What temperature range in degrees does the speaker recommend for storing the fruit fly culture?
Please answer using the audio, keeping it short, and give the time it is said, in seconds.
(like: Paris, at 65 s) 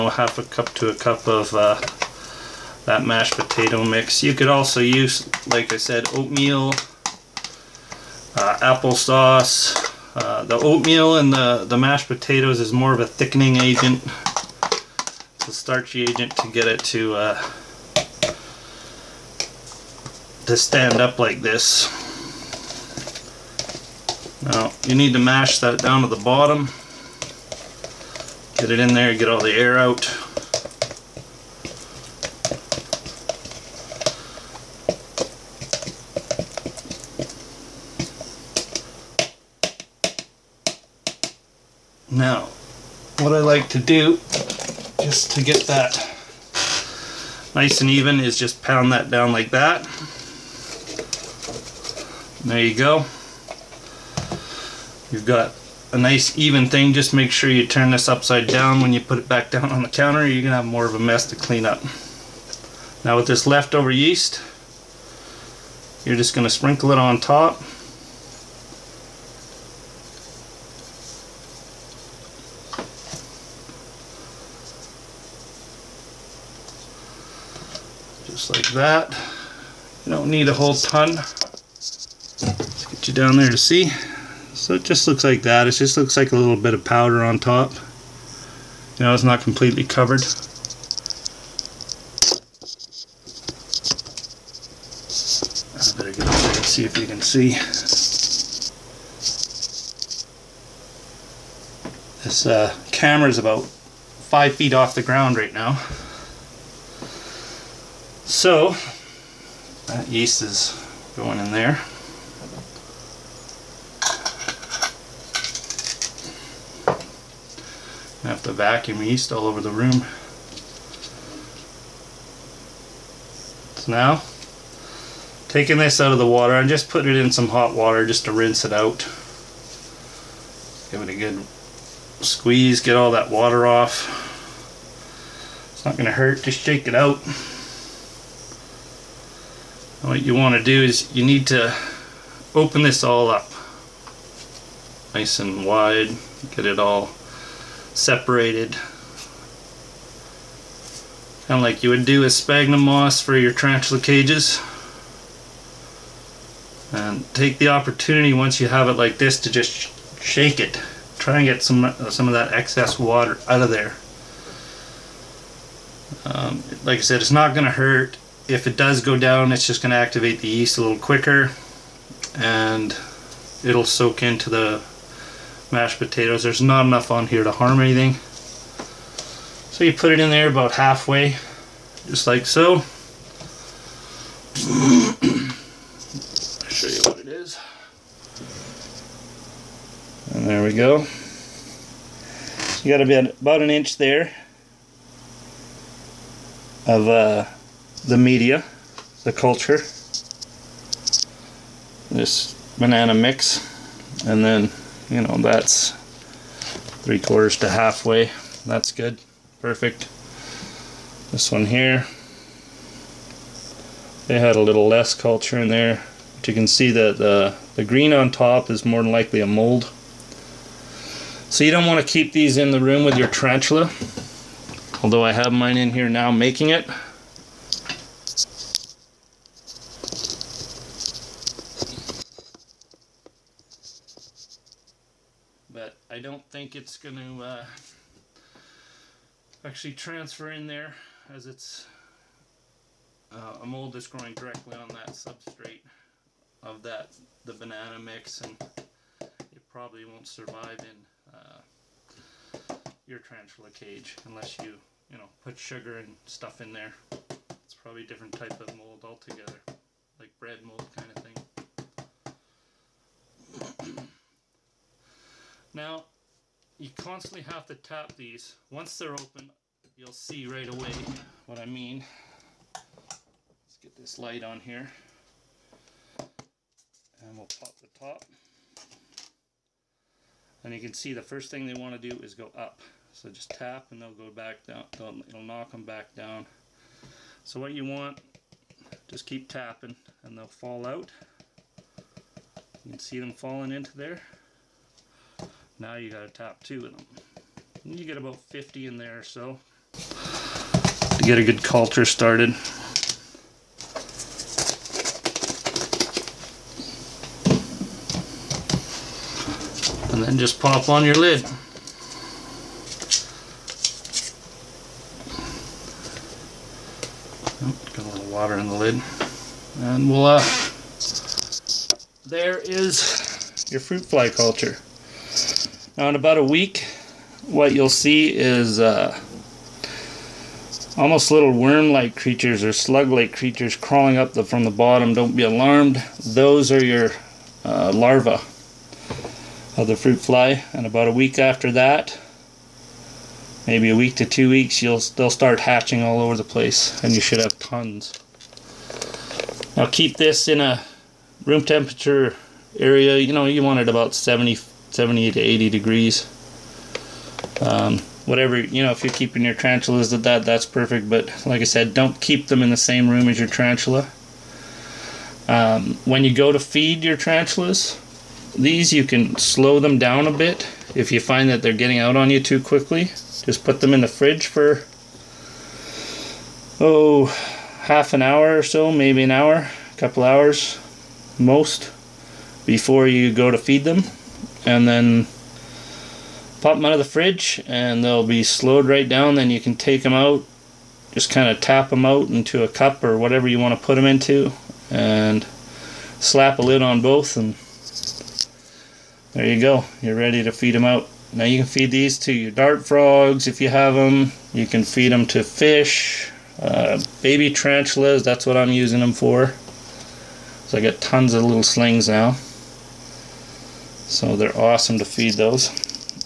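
70 to 80 degrees, at 354 s.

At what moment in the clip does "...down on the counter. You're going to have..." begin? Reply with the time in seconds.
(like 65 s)
59 s.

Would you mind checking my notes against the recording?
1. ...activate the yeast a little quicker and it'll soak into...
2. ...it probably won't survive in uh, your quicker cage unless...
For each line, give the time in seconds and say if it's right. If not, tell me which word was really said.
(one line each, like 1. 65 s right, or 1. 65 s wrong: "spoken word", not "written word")
1. 169 s right
2. 249 s wrong: "transfer", not "quicker".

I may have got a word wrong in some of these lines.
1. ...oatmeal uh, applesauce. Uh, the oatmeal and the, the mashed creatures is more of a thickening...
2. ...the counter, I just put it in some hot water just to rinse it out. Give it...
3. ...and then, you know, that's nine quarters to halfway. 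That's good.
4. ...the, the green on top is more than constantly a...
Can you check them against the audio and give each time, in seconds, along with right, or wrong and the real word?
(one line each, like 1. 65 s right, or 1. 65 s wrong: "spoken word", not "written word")
1. 6 s wrong: "potatoes", not "creatures"
2. 126 s wrong: "water", not "counter"
3. 204 s wrong: "three", not "nine"
4. 217 s wrong: "likely", not "constantly".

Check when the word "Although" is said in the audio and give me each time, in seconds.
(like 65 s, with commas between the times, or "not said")
225 s.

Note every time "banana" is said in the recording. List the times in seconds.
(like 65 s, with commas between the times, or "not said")
202 s, 247 s.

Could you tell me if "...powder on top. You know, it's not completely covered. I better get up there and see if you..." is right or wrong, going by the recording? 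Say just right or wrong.
right.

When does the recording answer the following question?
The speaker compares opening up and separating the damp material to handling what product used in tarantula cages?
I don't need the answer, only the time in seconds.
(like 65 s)
152 s.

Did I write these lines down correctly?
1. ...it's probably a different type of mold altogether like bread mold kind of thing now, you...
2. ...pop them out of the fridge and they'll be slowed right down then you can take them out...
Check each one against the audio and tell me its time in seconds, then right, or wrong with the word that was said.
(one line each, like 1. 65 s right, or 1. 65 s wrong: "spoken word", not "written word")
1. 257 s right
2. 386 s right.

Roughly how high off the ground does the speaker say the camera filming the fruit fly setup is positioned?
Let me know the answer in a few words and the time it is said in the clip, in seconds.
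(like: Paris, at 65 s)
5 feet, at 103 s.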